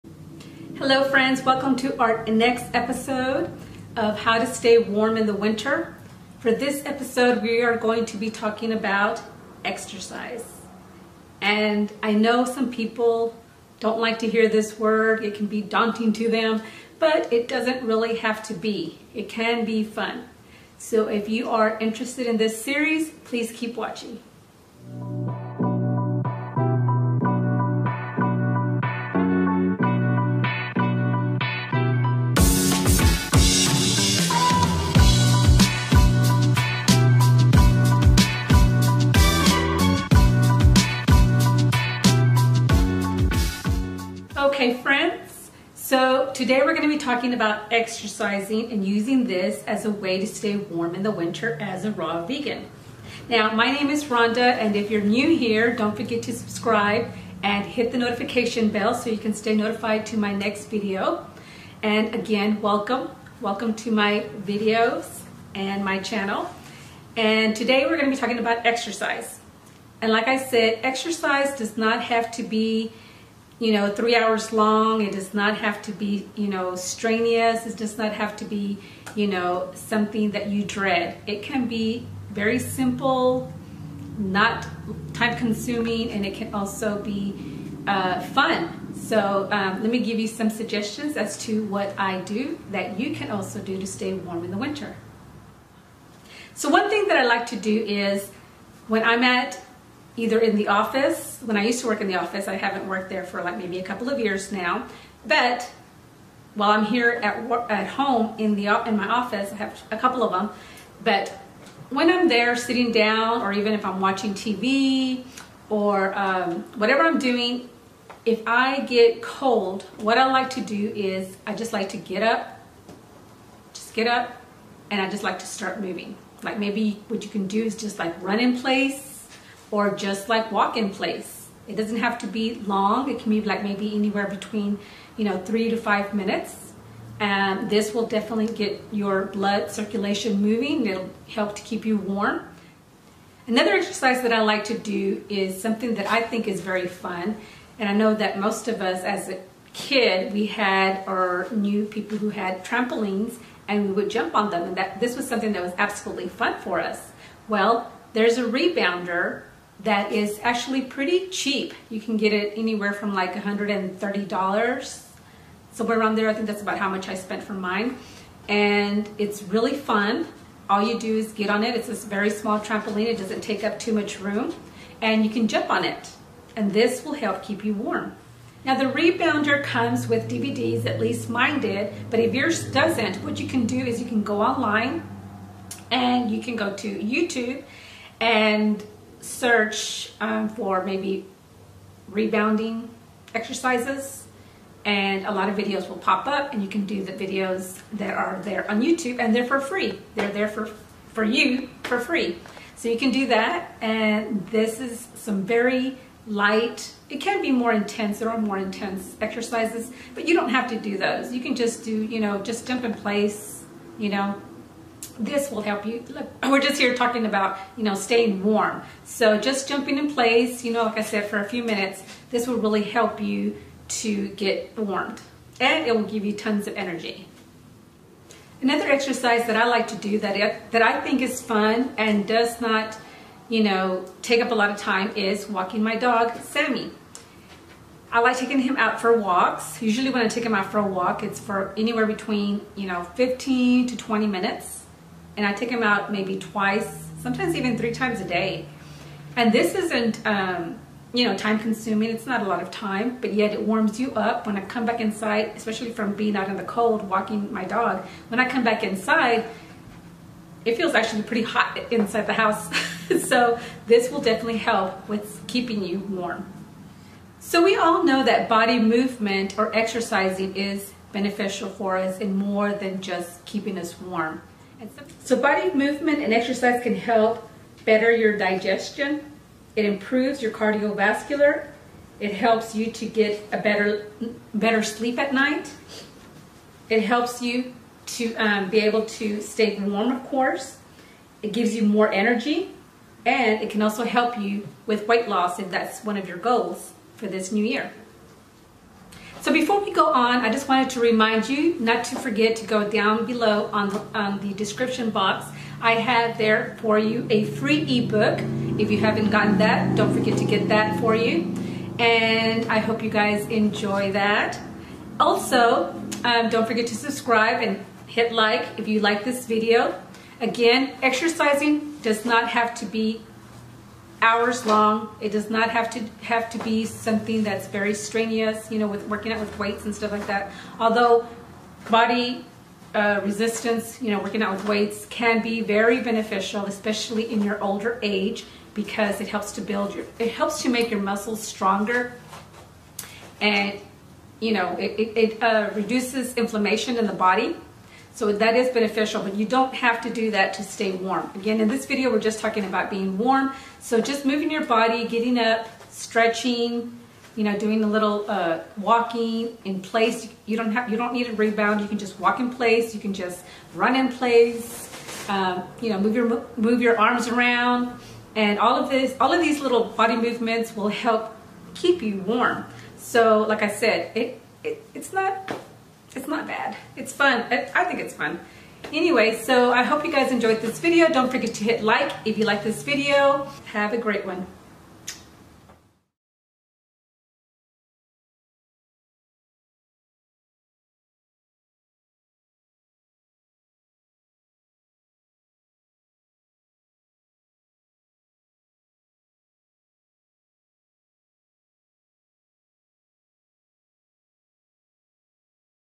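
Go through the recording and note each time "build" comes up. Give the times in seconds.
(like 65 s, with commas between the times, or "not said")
339 s.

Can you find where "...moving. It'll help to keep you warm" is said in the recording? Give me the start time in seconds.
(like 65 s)
140 s.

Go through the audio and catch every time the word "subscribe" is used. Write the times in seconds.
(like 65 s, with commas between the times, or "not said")
56 s, 316 s.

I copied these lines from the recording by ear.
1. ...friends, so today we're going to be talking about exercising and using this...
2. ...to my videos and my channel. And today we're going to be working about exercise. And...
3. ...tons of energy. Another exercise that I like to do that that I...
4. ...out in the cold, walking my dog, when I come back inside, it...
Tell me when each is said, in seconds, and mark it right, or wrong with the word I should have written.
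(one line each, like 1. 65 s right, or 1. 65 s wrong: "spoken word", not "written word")
1. 44 s right
2. 63 s wrong: "talking", not "working"
3. 226 s right
4. 256 s right.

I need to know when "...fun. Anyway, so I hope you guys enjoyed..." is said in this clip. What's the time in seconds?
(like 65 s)
378 s.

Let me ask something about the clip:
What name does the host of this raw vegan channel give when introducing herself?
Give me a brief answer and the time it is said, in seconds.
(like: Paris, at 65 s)
Rawnda, at 54 s.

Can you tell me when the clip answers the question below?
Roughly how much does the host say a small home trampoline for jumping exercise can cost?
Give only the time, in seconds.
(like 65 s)
163 s.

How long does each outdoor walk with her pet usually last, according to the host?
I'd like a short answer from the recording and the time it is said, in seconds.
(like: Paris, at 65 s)
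15 to 20 minutes, at 243 s.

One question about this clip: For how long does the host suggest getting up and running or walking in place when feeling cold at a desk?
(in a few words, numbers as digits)
3 to 5 minutes.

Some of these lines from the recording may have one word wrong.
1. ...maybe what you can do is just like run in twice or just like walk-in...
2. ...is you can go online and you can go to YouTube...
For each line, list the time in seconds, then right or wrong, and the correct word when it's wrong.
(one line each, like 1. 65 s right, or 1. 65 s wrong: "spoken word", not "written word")
1. 126 s wrong: "place", not "twice"
2. 183 s right.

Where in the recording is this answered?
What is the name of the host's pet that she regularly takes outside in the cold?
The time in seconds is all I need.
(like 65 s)
236 s.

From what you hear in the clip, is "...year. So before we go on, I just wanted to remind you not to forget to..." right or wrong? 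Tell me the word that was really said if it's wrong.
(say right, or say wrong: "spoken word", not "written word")
right.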